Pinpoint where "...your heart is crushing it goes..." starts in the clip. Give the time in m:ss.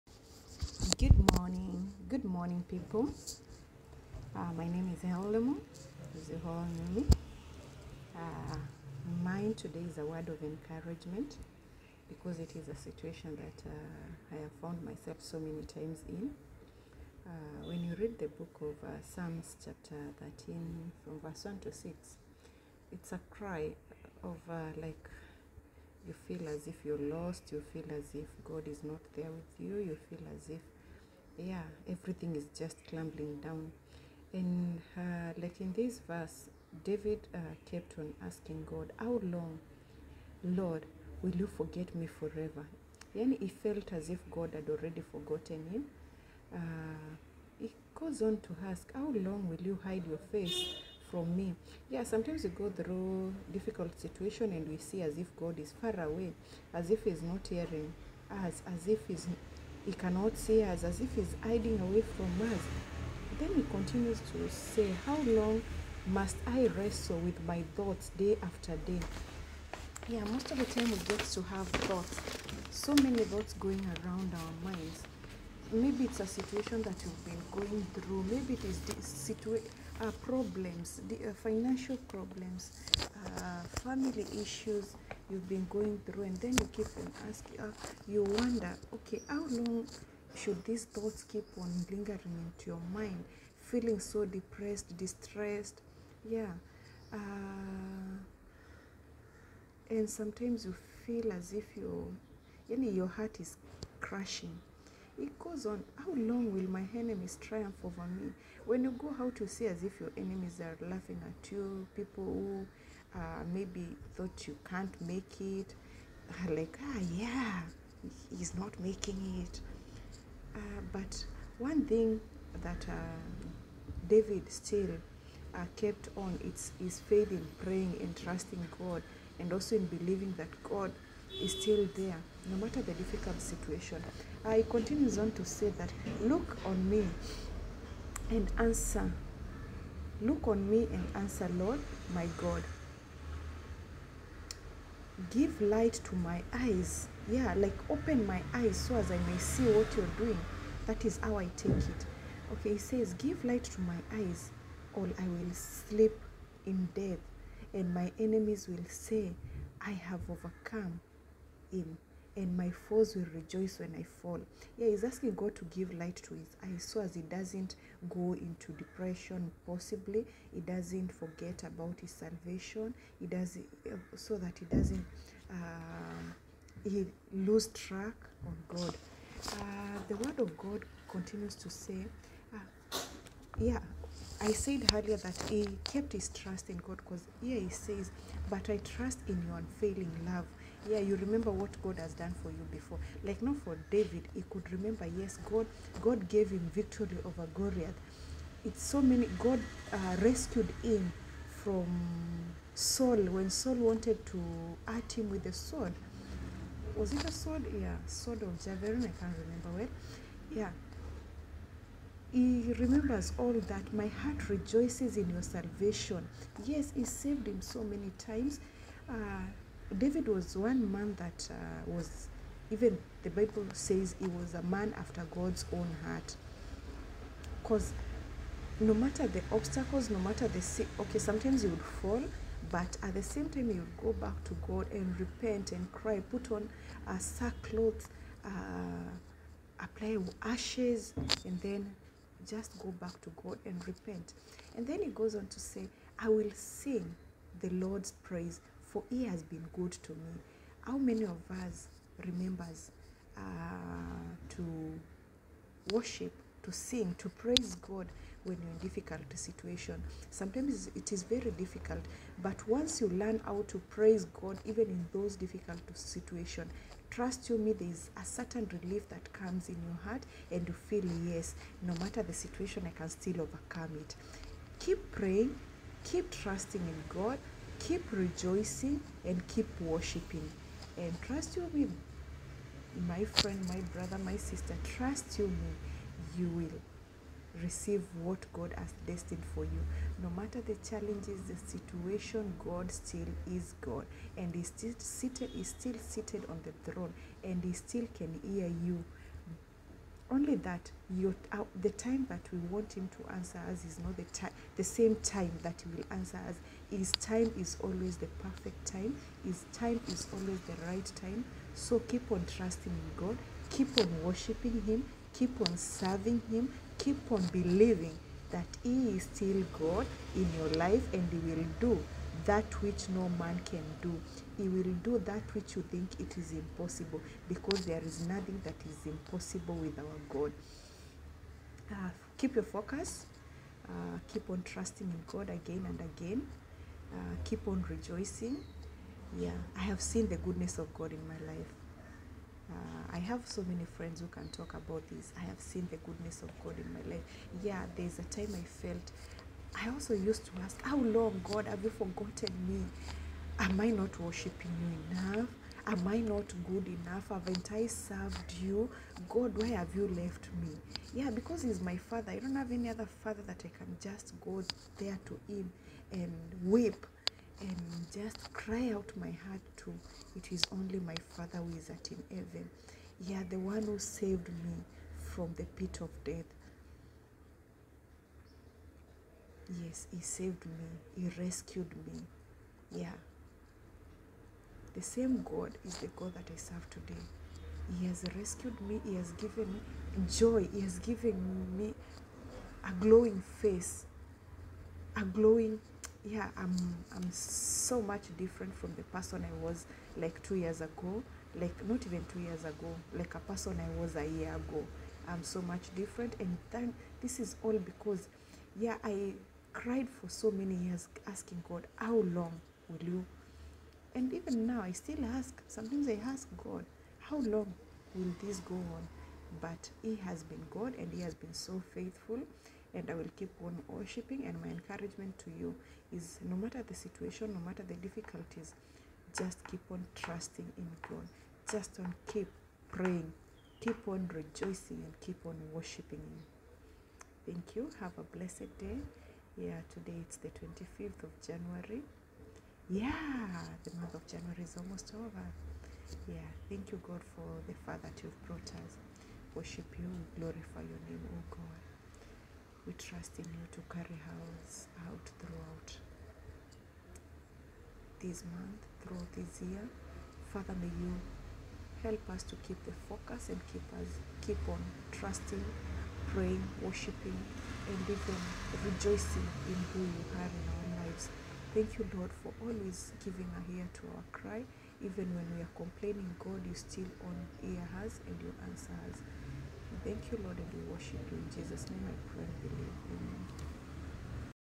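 1:42.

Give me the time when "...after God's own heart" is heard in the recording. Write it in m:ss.
3:44.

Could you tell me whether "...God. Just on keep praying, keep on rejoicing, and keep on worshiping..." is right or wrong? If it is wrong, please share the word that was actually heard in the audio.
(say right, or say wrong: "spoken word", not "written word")
right.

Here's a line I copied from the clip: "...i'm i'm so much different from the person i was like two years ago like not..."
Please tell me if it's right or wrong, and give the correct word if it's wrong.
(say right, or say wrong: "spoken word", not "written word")
right.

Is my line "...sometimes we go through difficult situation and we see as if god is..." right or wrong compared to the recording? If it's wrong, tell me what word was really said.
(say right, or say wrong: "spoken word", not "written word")
right.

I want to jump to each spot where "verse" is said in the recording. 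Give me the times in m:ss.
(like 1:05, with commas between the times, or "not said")
0:21, 0:36.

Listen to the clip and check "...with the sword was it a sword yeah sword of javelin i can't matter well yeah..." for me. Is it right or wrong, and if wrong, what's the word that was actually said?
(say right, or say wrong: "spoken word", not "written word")
wrong: "remember", not "matter".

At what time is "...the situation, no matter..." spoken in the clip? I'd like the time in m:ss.
7:06.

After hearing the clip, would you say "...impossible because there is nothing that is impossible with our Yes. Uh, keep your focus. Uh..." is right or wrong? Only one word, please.
wrong.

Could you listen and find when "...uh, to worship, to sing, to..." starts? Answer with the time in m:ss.
4:13.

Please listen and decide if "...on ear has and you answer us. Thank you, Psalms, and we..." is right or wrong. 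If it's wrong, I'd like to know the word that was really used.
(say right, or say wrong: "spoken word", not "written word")
wrong: "Lord", not "Psalms".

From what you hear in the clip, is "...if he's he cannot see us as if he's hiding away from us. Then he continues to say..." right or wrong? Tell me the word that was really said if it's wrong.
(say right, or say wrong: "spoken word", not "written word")
right.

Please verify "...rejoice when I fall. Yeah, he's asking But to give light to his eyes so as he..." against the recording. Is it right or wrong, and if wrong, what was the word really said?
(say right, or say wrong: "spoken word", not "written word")
wrong: "God", not "But".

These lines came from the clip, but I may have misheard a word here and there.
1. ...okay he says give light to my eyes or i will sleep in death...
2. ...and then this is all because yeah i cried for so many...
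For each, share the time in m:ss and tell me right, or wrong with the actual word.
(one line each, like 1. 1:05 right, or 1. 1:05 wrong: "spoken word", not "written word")
1. 2:32 right
2. 6:46 right.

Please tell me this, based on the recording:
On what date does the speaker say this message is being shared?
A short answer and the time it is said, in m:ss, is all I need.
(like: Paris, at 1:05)
25th of January, at 7:20.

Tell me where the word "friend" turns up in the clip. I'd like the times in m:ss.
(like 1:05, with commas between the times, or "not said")
4:43, 5:43.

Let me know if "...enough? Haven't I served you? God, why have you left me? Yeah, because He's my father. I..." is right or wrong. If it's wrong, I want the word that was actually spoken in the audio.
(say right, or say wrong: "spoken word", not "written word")
right.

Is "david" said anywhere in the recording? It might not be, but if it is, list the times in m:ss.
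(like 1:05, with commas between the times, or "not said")
0:36, 2:04, 3:13, 3:39.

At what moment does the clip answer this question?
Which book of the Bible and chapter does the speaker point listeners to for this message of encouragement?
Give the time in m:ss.
0:19.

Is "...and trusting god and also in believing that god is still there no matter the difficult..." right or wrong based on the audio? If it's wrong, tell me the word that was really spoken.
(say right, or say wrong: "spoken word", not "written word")
right.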